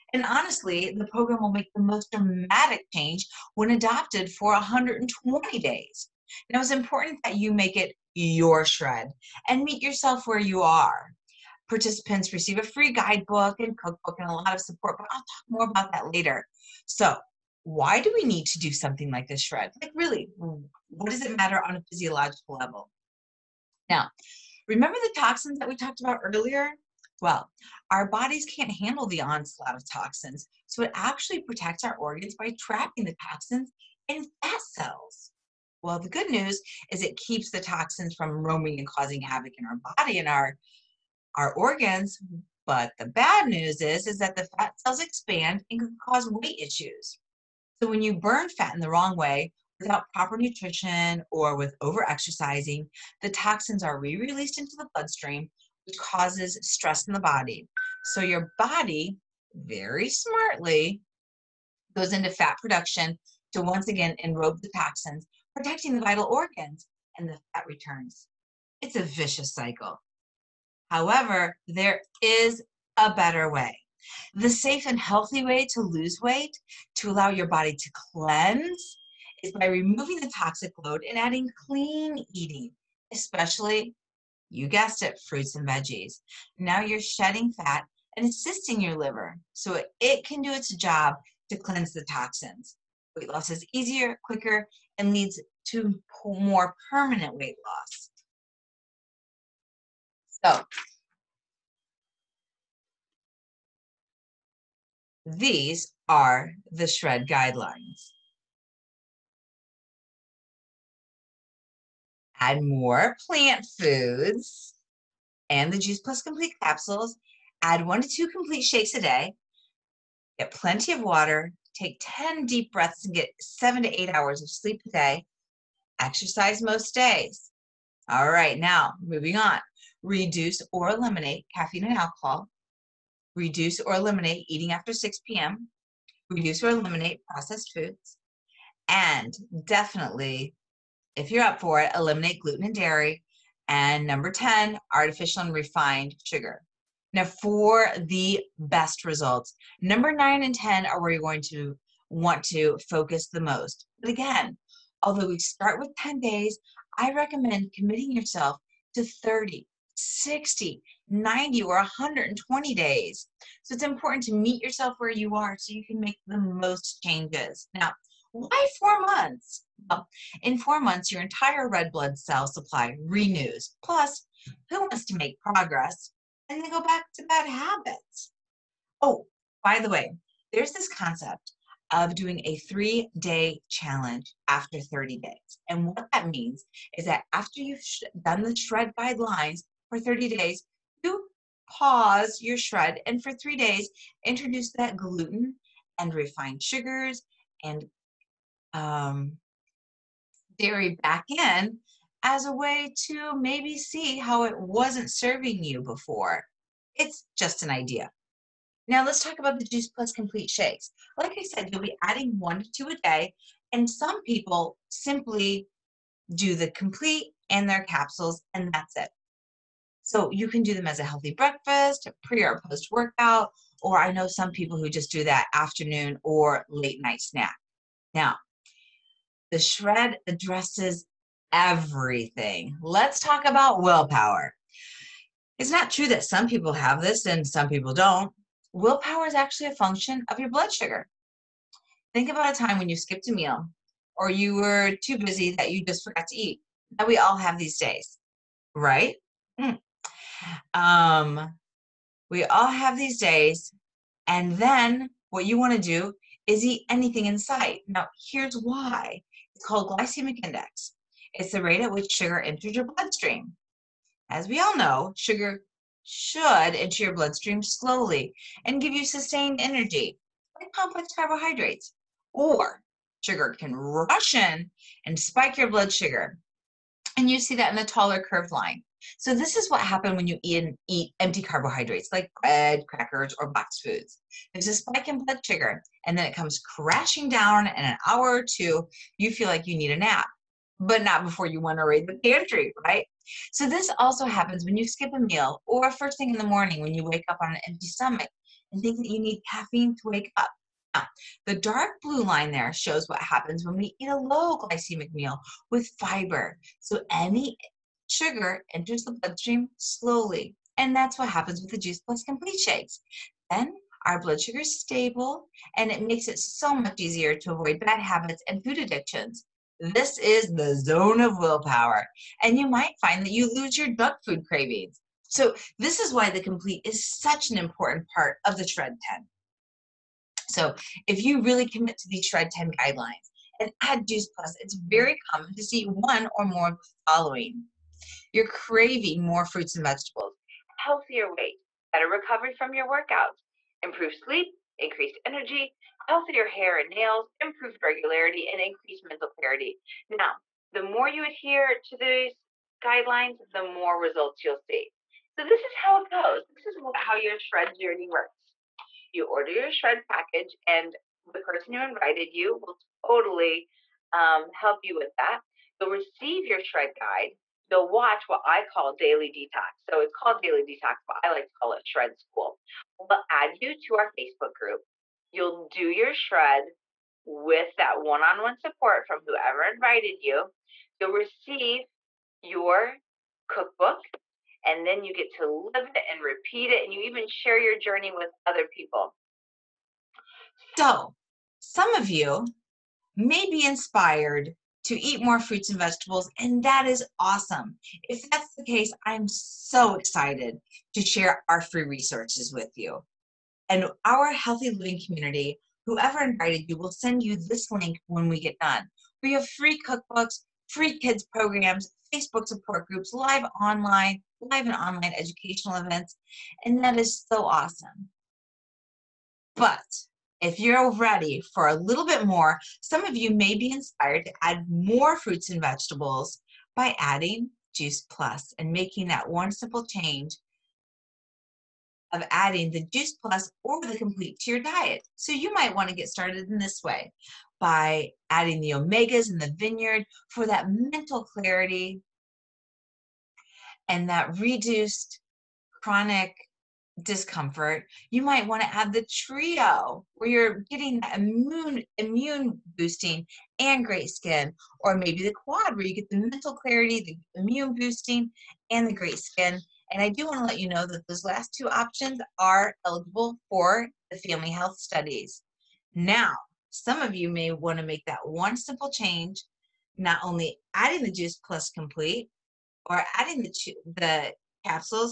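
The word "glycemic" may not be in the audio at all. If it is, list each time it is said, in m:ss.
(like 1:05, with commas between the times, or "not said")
4:19, 5:04.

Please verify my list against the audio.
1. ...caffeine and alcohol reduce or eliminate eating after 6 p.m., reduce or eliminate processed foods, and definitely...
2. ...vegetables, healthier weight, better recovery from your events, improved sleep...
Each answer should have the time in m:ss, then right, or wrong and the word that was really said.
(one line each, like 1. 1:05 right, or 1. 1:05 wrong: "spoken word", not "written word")
1. 2:11 right
2. 5:39 wrong: "workouts", not "events".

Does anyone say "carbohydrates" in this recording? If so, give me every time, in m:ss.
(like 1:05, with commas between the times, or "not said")
4:31, 4:41.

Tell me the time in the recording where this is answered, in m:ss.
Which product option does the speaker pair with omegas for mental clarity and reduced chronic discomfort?
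7:19.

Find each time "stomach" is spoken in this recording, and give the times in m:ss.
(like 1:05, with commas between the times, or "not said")
4:57.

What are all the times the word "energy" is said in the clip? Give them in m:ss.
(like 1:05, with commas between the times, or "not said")
4:29, 5:45.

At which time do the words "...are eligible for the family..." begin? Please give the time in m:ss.
7:42.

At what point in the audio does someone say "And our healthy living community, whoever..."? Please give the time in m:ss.
6:43.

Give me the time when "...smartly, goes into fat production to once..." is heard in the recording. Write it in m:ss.
1:00.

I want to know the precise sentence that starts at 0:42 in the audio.
But the bad news is, is that the fat cells expand and can cause weight issues.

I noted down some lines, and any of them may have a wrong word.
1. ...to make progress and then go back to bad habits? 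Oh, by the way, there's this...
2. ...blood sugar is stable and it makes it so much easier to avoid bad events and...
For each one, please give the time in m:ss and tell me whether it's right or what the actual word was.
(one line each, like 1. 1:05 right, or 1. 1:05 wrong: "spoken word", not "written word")
1. 2:55 right
2. 5:14 wrong: "habits", not "events".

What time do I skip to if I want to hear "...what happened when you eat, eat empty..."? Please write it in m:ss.
4:39.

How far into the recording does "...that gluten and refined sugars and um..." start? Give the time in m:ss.
3:14.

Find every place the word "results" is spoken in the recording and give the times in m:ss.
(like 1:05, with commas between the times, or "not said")
2:29, 5:54.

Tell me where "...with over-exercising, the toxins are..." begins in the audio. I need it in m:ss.
0:51.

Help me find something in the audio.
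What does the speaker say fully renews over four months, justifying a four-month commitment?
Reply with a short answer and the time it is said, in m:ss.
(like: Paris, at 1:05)
Red blood cell supply, at 2:51.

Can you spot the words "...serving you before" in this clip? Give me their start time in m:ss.
3:25.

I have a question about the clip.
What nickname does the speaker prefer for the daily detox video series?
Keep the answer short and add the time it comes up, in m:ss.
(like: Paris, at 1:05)
Shred school, at 6:11.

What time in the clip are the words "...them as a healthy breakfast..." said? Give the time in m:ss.
3:40.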